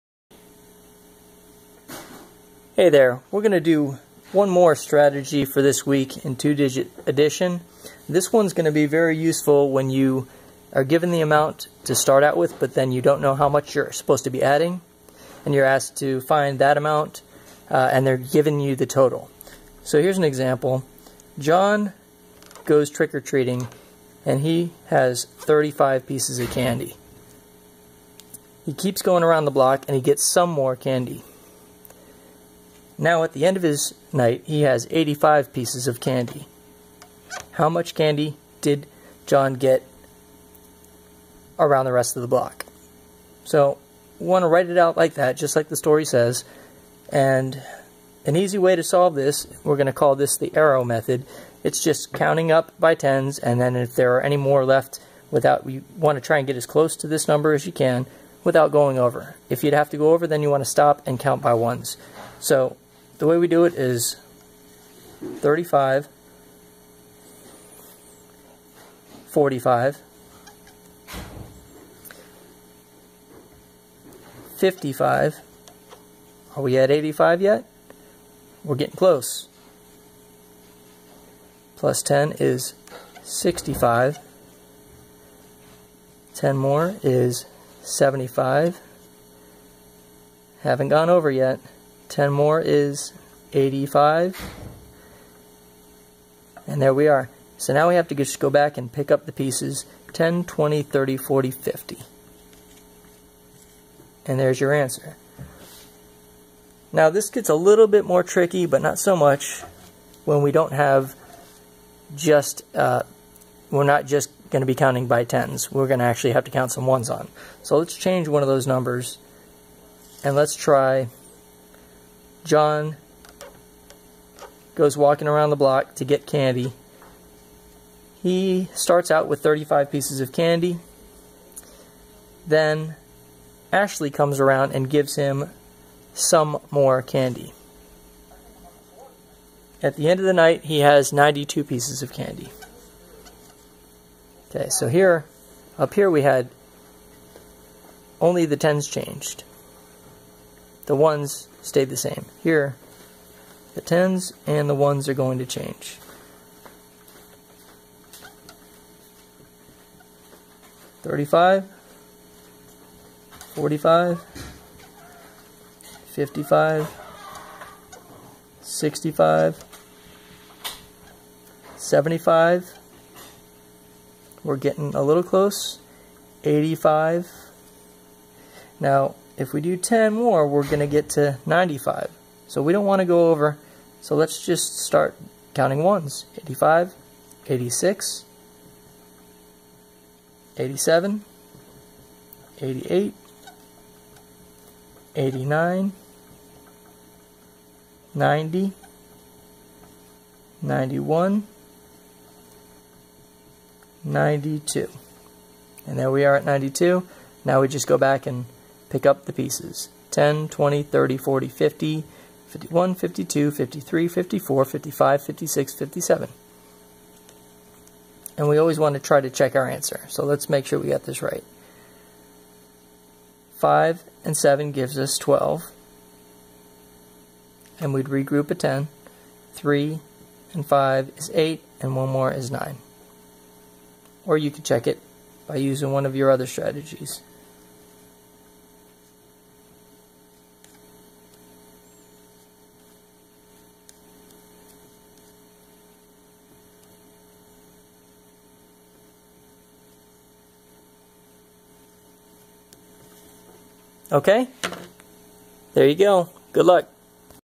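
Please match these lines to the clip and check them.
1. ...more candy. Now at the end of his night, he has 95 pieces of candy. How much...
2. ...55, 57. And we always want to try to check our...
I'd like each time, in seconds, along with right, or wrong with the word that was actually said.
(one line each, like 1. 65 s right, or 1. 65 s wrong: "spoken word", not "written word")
1. 30 s wrong: "85", not "95"
2. 215 s wrong: "56", not "55".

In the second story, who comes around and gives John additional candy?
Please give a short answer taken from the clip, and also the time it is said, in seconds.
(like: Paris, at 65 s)
Ashley, at 133 s.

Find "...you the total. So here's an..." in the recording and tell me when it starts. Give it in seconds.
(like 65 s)
18 s.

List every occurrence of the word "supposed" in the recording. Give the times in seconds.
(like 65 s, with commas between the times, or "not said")
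13 s.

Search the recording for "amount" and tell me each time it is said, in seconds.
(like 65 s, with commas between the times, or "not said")
11 s, 16 s.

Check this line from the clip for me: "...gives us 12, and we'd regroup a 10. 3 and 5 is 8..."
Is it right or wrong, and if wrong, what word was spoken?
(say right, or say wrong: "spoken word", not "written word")
right.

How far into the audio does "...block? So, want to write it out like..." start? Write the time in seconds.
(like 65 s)
42 s.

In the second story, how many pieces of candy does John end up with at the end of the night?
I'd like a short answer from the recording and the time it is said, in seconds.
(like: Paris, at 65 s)
92, at 141 s.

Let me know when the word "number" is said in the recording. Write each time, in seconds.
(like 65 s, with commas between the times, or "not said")
57 s, 118 s.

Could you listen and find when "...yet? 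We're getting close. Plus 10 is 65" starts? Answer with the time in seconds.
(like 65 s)
77 s.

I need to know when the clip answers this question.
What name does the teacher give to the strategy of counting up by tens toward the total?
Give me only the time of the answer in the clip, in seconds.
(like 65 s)
50 s.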